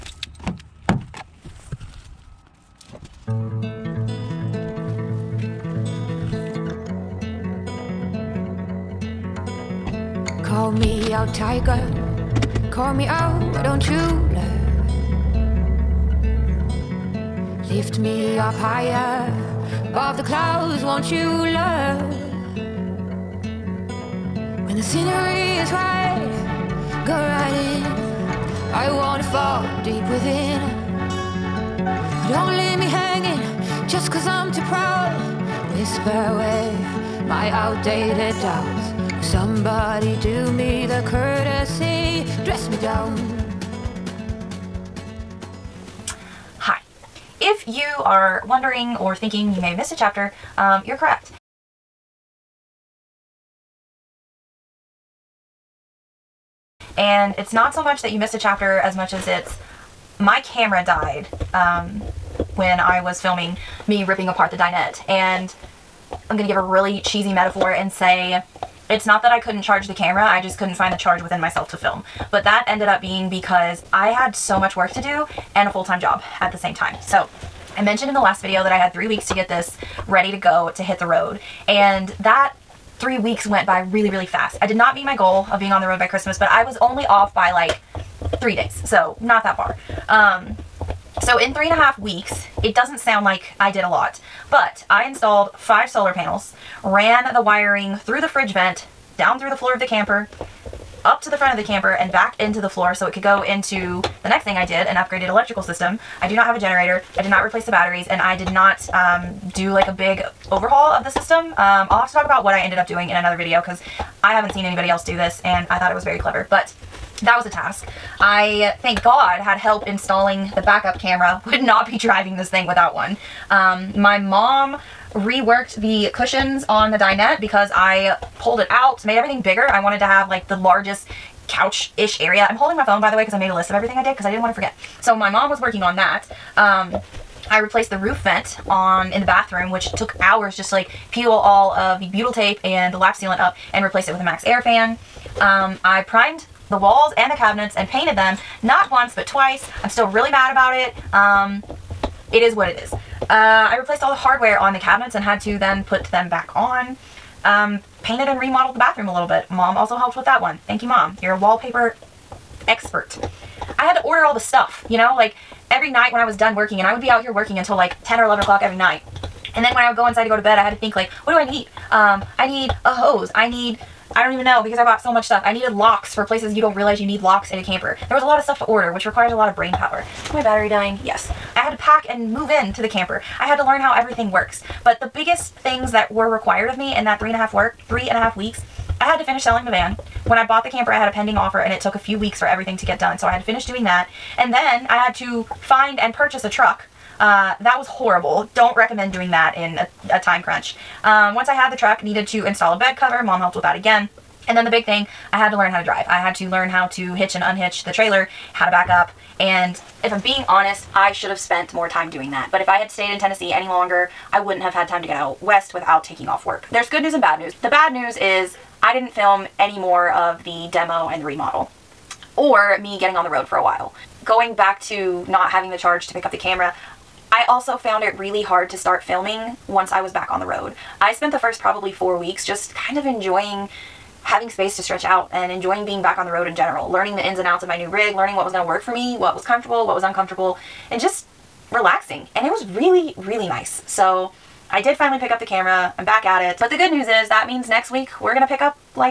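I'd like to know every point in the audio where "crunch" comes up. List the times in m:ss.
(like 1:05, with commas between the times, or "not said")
3:20.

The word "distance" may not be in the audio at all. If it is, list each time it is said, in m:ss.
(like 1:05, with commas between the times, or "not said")
not said.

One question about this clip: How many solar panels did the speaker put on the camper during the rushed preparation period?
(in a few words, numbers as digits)
5.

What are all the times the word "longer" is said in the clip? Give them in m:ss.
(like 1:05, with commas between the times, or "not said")
3:33.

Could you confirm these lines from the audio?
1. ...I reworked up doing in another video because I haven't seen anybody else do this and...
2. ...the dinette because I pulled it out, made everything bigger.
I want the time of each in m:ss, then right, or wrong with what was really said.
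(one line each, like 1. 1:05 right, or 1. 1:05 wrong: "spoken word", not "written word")
1. 1:52 wrong: "ended", not "reworked"
2. 2:06 right.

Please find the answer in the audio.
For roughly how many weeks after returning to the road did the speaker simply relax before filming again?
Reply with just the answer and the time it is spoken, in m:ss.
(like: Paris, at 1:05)
4, at 3:51.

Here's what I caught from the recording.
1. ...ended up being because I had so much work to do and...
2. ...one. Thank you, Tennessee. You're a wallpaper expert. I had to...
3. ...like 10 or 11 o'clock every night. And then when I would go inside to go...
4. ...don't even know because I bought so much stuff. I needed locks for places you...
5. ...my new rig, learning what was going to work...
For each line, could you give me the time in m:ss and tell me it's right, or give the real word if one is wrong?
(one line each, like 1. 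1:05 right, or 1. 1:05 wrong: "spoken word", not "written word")
1. 1:12 right
2. 2:40 wrong: "Mom", not "Tennessee"
3. 2:47 right
4. 2:54 right
5. 3:57 right.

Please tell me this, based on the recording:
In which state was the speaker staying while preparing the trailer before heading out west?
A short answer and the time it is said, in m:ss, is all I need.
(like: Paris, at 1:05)
Tennessee, at 3:33.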